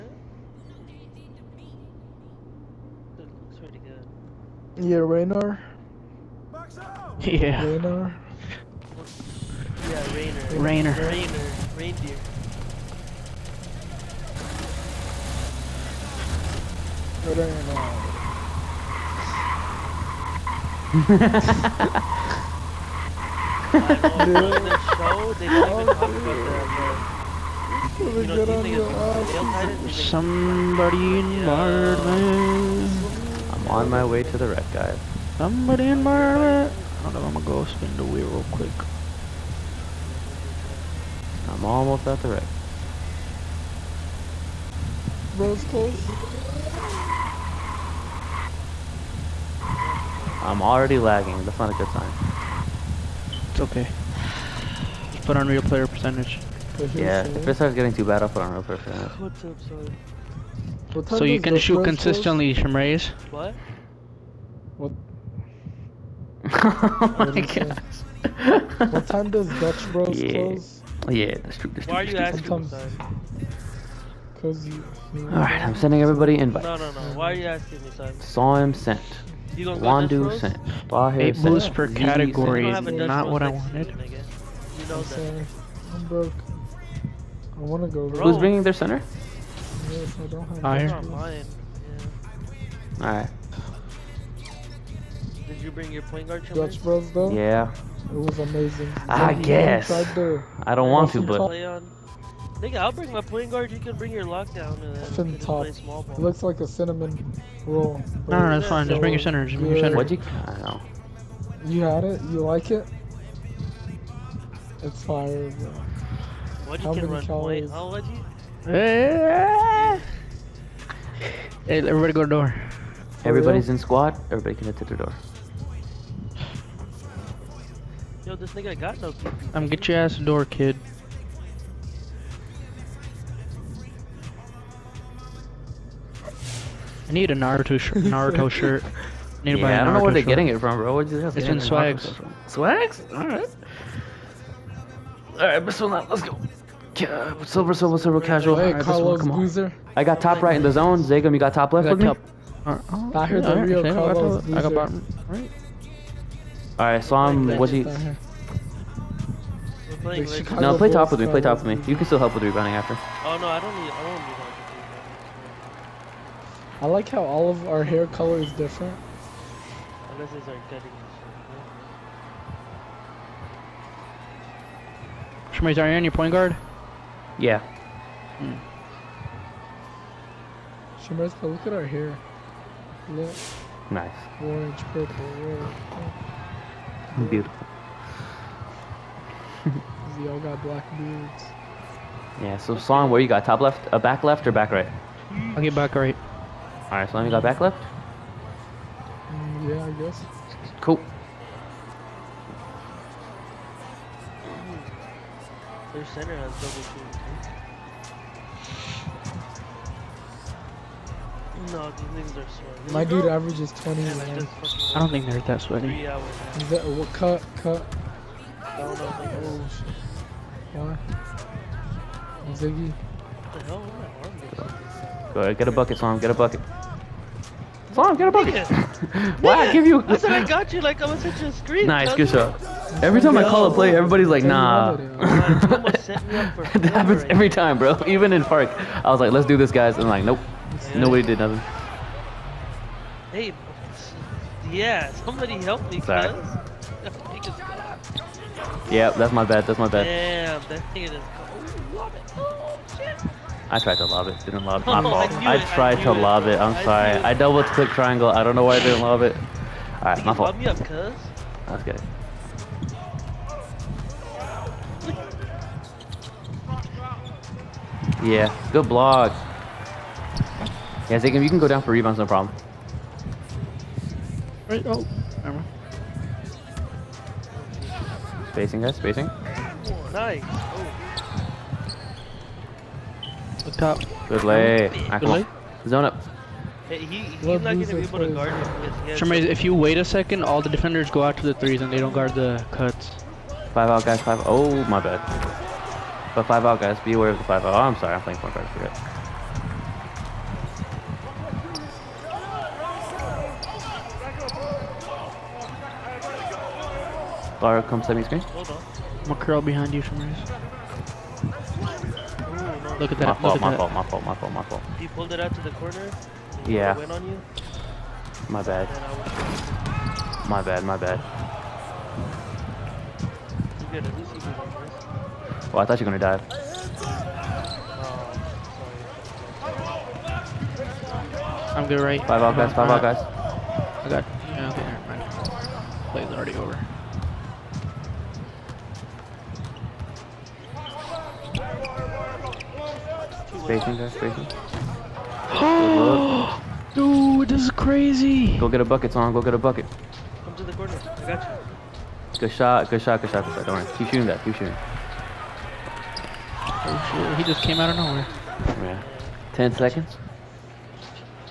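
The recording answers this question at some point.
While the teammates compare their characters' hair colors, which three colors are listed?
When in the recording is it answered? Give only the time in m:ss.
3:04.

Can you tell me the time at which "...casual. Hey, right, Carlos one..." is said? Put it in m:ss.
2:28.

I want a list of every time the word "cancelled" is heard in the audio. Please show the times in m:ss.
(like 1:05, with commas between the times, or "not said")
not said.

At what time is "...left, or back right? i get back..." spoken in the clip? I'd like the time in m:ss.
3:14.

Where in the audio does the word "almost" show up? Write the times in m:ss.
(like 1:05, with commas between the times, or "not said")
0:41.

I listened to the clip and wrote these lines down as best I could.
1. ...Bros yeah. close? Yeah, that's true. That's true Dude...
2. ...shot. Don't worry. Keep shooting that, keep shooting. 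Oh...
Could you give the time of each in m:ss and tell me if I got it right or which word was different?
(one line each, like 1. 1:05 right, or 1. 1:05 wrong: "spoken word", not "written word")
1. 1:09 wrong: "Why", not "Dude"
2. 5:53 right.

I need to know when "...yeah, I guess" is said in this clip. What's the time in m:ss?
3:19.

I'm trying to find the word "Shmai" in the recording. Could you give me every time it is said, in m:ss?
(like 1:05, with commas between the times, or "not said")
2:55, 3:01.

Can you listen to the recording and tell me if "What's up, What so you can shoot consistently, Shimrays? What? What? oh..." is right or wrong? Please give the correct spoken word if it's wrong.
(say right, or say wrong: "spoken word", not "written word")
right.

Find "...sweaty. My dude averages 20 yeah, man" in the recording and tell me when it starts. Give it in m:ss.
3:32.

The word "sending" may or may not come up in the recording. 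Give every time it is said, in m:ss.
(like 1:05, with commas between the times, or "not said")
1:15.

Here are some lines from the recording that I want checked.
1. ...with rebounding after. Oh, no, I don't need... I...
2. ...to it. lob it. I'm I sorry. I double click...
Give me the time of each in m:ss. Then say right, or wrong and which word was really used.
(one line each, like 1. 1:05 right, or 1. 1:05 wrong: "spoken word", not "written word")
1. 2:42 right
2. 4:16 right.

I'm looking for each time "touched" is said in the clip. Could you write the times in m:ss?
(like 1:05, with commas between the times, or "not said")
not said.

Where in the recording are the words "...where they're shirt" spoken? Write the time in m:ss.
2:20.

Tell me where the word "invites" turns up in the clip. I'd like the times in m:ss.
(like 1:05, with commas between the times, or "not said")
1:16.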